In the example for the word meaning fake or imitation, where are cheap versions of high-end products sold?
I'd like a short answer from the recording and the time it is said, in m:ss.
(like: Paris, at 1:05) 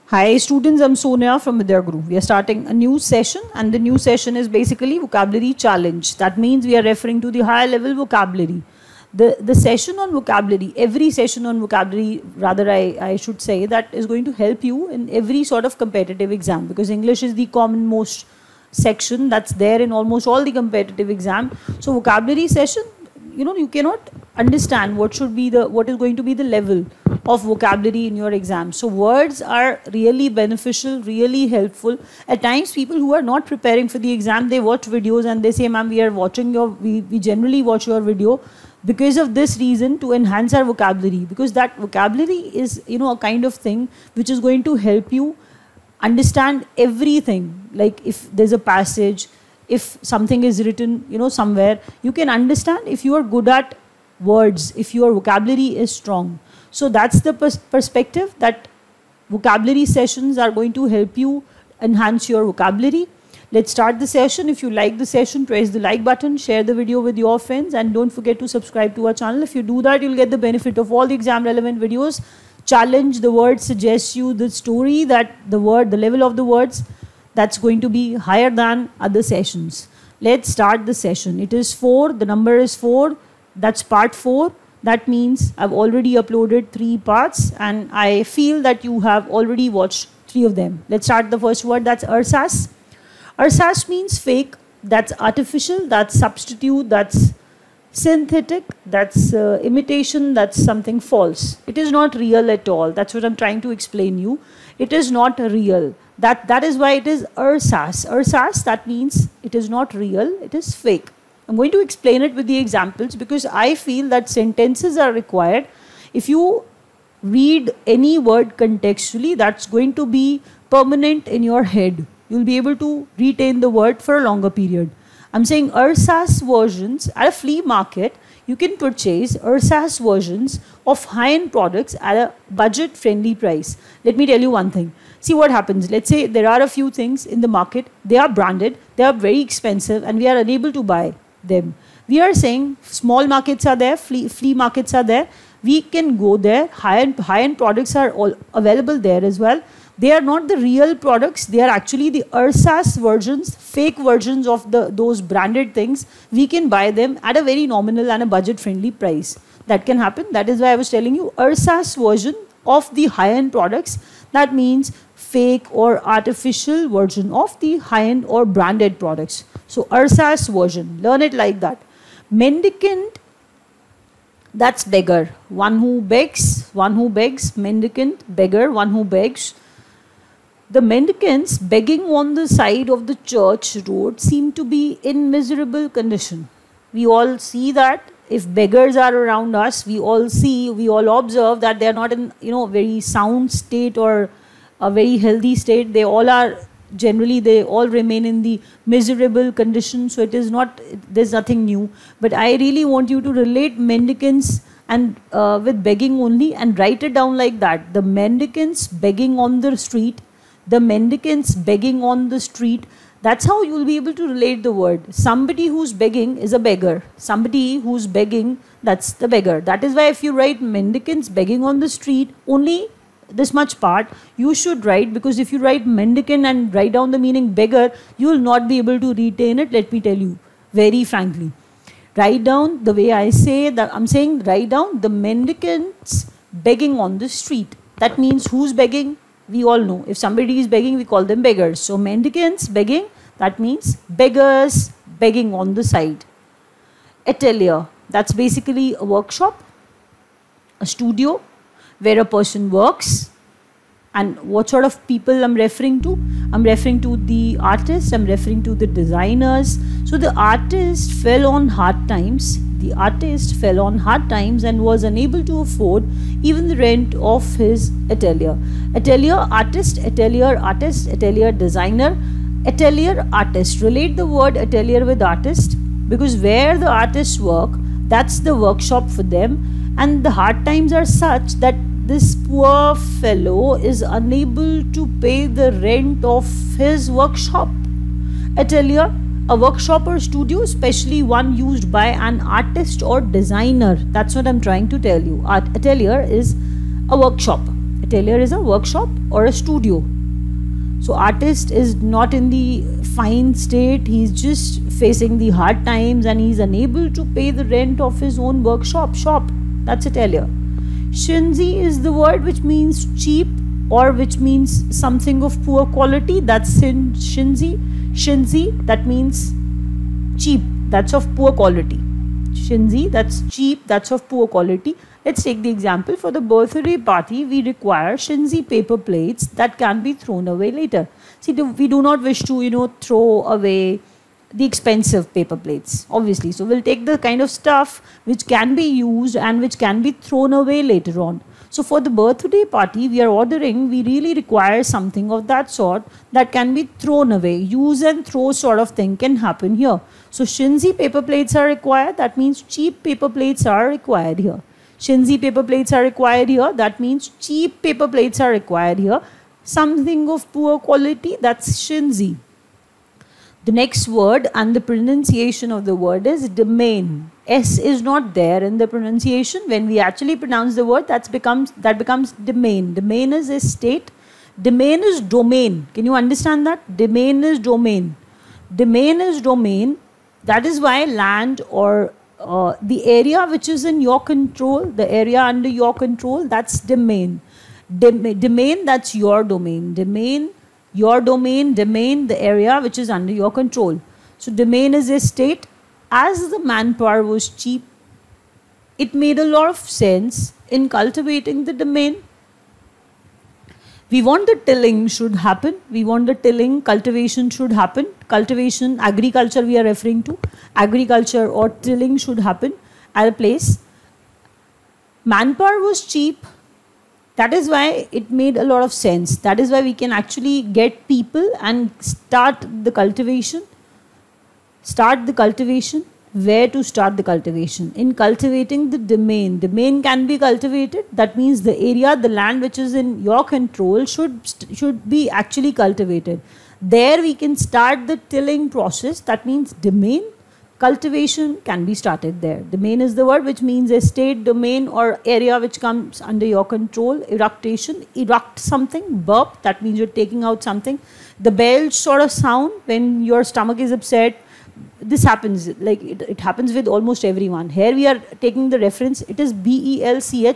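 flea market, at 2:07.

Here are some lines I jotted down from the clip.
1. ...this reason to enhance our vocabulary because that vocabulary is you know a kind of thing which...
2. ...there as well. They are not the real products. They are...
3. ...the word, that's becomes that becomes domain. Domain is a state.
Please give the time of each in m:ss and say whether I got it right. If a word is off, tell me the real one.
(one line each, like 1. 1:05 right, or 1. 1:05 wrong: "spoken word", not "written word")
1. 0:39 right
2. 2:29 right
3. 6:10 right.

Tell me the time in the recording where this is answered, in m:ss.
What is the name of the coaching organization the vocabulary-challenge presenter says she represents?
0:01.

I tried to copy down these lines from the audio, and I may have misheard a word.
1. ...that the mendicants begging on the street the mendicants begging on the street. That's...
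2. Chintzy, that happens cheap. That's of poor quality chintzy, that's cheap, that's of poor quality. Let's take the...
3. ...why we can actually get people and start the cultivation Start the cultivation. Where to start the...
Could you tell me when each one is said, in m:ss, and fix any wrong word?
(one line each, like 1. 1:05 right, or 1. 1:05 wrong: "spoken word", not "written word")
1. 3:27 right
2. 5:18 wrong: "means", not "happens"
3. 6:59 right.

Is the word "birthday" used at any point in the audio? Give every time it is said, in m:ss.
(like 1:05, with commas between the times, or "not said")
5:26, 5:42.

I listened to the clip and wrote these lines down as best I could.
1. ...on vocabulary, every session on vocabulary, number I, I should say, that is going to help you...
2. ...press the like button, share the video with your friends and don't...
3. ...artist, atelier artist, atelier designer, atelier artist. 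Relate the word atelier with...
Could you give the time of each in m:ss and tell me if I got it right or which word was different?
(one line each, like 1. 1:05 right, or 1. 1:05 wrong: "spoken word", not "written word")
1. 0:10 wrong: "rather", not "number"
2. 1:05 right
3. 4:29 right.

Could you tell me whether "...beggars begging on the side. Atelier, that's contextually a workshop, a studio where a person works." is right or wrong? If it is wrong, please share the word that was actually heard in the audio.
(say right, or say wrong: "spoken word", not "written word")
wrong: "basically", not "contextually".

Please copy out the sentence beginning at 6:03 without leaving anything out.
The next word and the pronunciation of the word is domain.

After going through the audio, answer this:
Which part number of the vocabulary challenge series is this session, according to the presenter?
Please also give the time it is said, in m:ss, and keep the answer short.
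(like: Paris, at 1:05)
4, at 1:23.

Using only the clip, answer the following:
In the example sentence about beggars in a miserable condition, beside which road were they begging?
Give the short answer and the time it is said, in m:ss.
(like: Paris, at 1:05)
church road, at 3:02.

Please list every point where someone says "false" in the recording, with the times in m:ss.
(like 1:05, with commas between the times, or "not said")
1:41.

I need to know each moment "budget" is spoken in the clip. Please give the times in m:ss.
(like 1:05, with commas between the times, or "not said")
2:12, 2:38.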